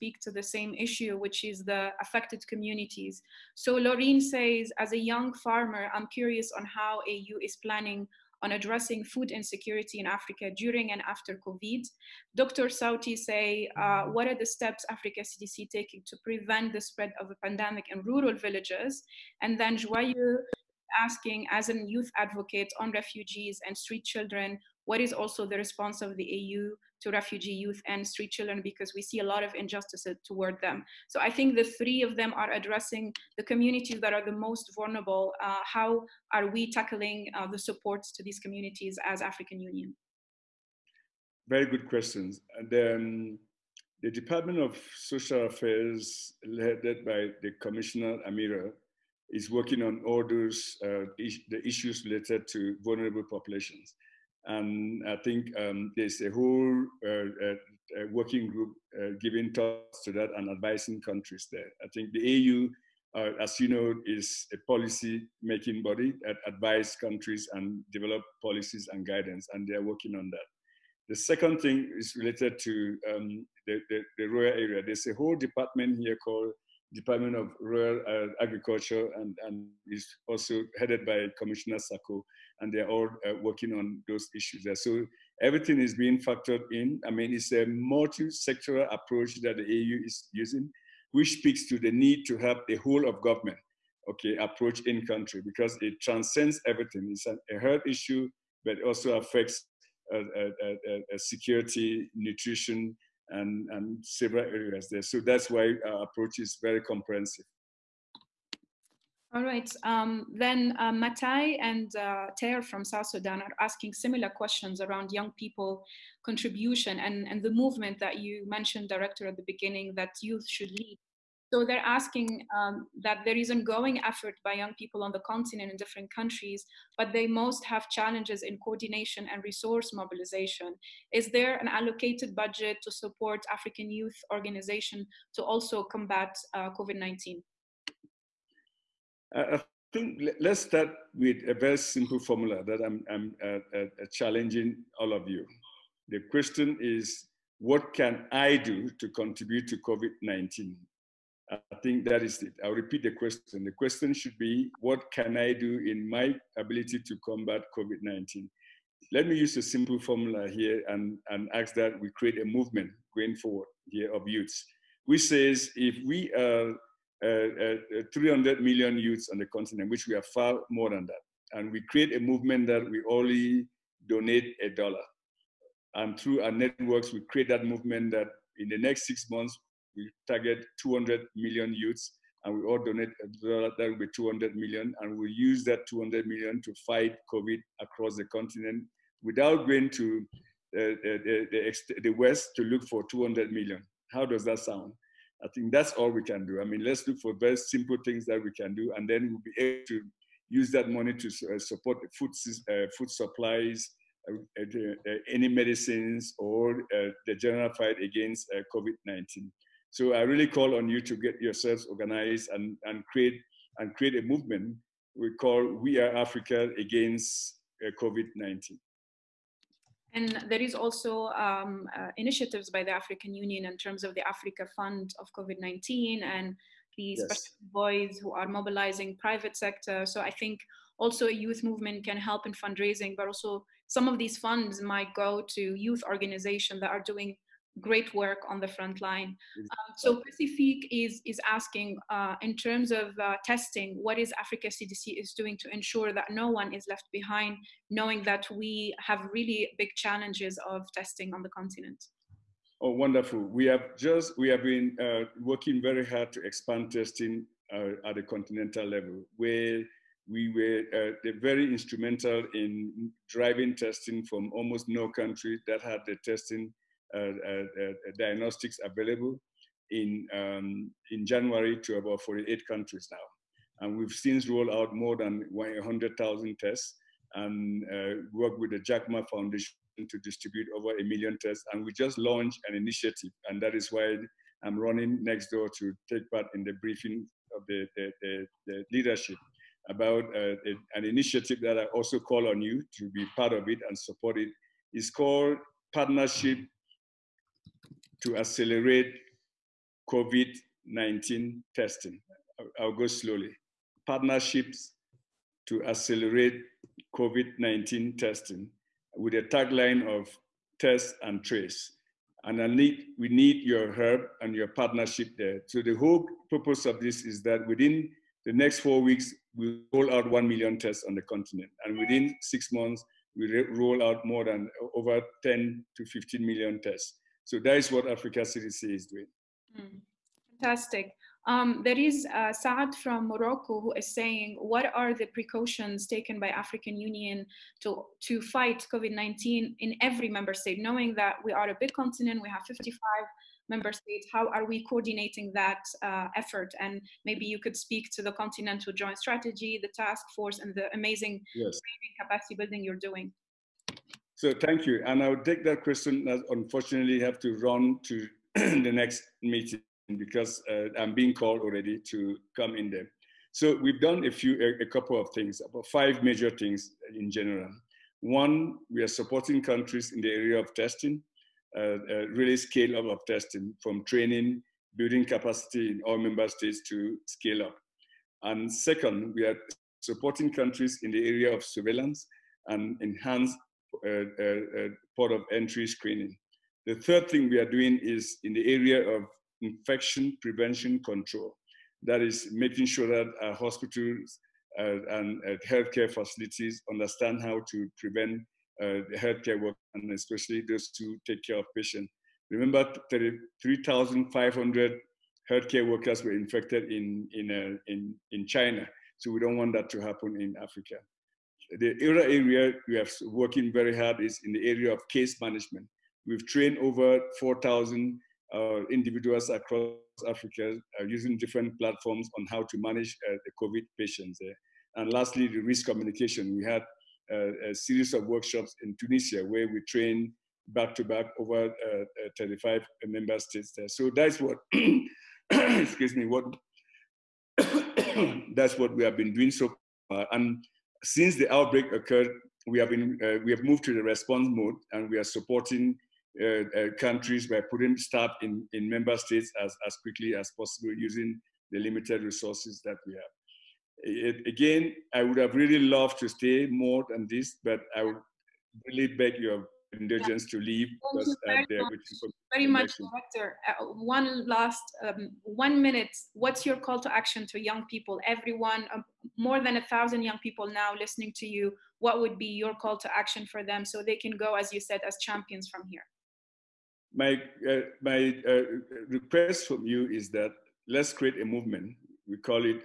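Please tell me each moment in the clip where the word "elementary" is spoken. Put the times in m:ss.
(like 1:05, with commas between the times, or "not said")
not said.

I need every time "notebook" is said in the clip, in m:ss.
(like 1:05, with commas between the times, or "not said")
not said.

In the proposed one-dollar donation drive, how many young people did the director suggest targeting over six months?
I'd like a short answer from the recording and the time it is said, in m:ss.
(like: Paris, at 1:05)
200 million, at 3:00.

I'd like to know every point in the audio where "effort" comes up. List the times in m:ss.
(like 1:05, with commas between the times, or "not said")
2:04, 5:46.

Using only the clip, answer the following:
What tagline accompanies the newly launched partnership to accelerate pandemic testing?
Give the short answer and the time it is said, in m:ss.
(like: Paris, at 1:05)
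test and trace, at 5:10.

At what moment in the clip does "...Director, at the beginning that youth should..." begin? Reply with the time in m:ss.
1:58.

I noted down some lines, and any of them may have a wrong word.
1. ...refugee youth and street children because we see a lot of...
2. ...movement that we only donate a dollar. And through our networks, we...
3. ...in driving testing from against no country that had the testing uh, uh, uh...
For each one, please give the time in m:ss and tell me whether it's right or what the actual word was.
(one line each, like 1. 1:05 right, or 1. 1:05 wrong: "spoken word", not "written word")
1. 0:27 right
2. 2:52 right
3. 4:22 wrong: "almost", not "against".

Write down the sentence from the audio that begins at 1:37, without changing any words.
It's an, a health issue, but also affects uh uh, uh, uh, uh, security, nutrition, and, and several areas there.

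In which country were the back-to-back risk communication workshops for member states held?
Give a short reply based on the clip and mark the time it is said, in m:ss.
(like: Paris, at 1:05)
Tunisia, at 7:08.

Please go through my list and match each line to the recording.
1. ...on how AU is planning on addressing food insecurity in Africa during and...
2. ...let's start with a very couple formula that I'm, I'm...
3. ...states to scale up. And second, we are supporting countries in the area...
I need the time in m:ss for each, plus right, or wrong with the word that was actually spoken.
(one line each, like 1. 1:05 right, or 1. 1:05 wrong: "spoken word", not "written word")
1. 0:06 right
2. 2:20 wrong: "simple", not "couple"
3. 6:16 right.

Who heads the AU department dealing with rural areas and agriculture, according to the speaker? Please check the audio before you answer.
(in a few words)
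Commissioner Sacko.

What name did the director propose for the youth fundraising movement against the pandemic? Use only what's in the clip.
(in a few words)
We Are Africa Against COVID-19.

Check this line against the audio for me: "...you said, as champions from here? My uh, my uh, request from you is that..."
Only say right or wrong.
right.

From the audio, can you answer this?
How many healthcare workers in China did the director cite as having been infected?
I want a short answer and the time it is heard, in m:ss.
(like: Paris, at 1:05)
3,500, at 6:43.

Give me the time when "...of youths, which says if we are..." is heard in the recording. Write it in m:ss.
2:44.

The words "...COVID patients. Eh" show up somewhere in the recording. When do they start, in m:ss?
7:03.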